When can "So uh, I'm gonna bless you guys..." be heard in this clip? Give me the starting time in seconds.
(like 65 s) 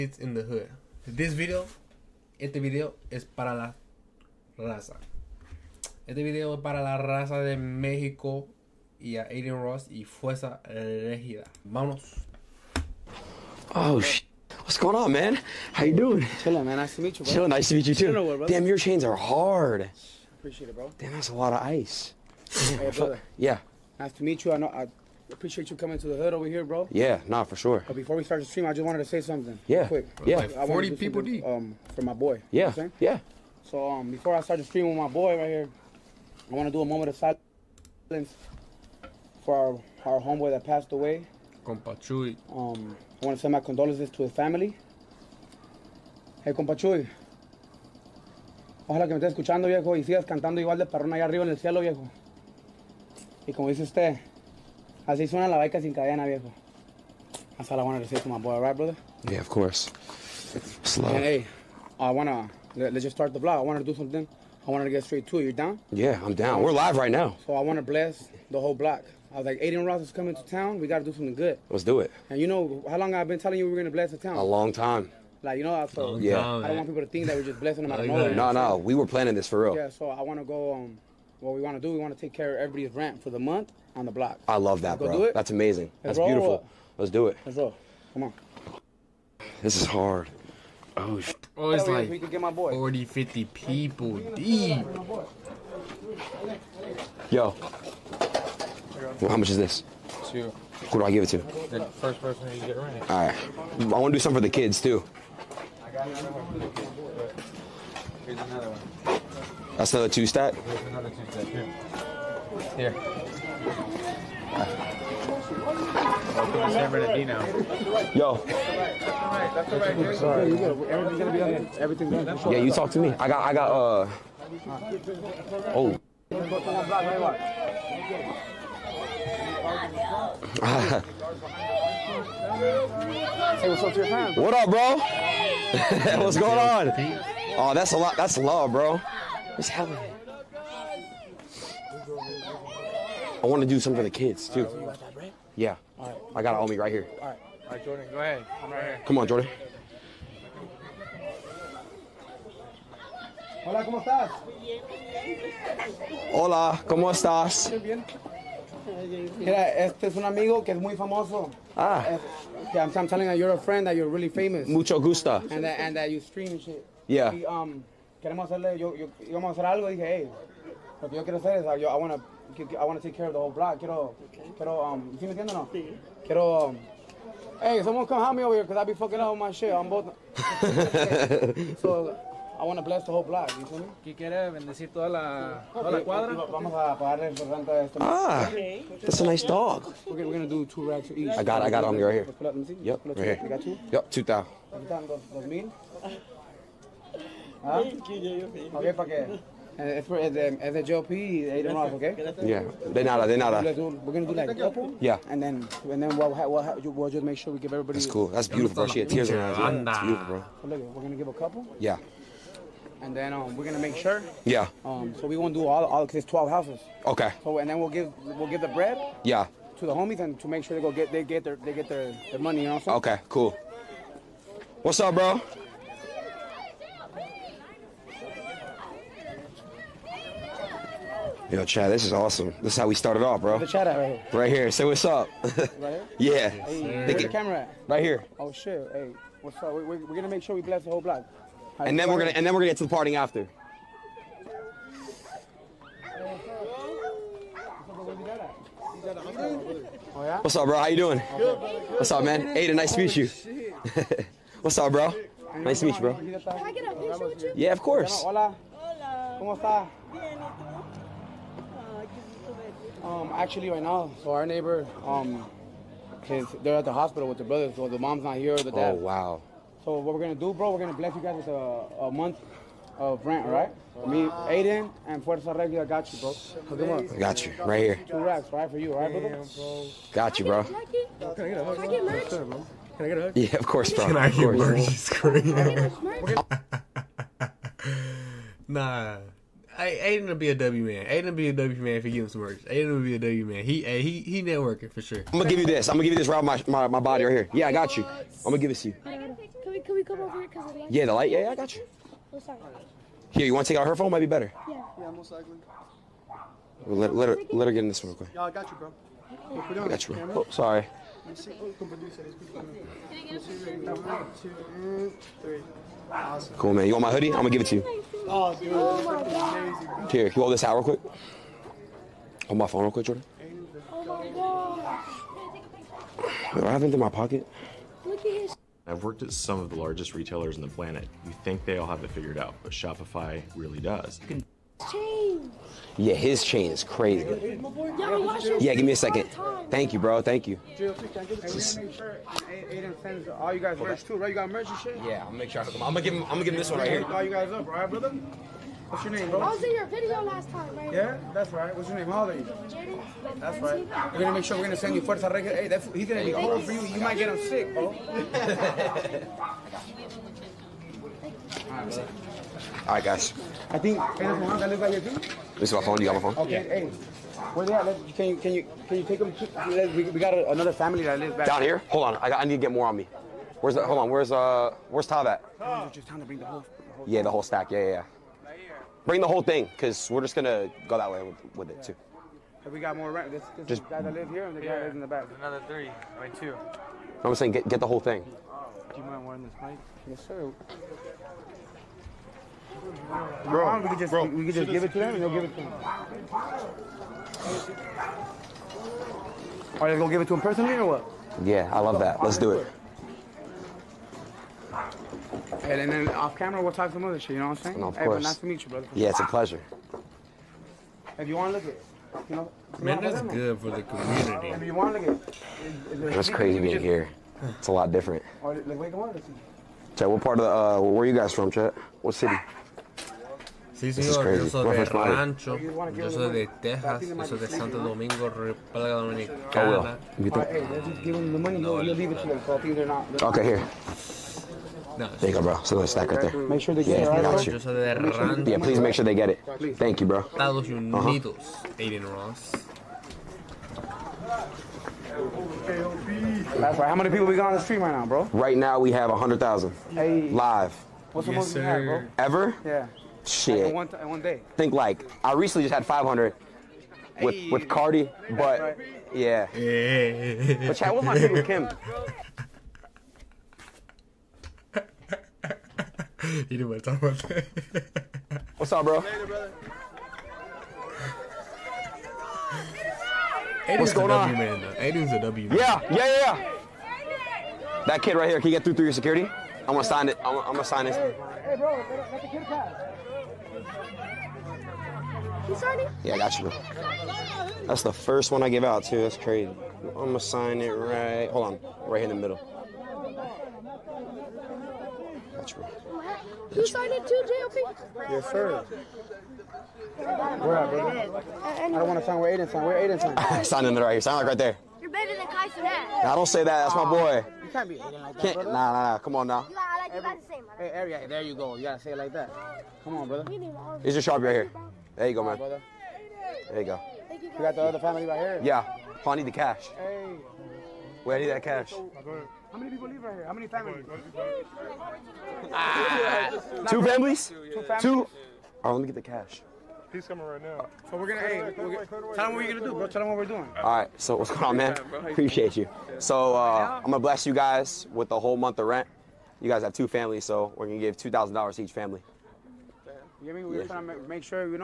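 535 s.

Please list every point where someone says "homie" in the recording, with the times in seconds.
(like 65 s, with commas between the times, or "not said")
146 s, 219 s.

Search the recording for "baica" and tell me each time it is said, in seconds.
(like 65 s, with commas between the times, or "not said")
55 s.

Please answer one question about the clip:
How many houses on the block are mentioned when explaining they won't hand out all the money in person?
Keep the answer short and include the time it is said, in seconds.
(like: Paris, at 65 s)
12, at 216 s.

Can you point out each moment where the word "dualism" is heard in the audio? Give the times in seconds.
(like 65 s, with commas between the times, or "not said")
not said.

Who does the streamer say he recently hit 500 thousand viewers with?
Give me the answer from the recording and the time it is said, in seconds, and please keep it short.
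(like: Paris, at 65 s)
Cardi, at 457 s.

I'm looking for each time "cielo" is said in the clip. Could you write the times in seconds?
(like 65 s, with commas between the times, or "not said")
51 s.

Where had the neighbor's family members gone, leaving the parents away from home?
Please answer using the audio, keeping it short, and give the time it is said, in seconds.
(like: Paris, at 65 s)
the hospital, at 266 s.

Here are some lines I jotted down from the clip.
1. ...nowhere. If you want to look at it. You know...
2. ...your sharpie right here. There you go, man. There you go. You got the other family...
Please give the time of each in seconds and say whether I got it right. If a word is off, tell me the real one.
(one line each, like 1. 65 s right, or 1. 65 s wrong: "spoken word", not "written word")
1. 409 s wrong: "pleasure", not "nowhere"
2. 513 s right.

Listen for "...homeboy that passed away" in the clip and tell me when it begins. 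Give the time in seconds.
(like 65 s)
40 s.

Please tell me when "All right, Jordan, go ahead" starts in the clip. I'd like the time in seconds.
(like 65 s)
147 s.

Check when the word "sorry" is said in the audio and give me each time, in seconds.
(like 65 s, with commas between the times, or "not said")
302 s, 310 s.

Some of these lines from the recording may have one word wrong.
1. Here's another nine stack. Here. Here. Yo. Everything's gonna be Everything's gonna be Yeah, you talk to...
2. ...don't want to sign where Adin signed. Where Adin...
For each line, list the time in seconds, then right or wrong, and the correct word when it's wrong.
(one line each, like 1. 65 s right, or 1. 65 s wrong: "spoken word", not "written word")
1. 110 s wrong: "two", not "nine"
2. 501 s right.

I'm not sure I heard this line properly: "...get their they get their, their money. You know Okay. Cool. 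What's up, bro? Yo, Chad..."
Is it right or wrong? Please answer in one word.
right.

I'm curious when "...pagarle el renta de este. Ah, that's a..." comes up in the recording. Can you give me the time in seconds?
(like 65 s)
186 s.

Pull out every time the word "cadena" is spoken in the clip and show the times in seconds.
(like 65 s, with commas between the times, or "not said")
55 s.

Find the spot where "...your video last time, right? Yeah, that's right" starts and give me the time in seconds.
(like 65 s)
349 s.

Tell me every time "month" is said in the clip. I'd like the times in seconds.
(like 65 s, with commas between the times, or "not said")
83 s, 272 s, 538 s.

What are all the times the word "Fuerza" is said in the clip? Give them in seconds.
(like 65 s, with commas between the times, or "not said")
10 s, 275 s, 355 s.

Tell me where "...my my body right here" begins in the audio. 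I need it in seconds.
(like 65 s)
296 s.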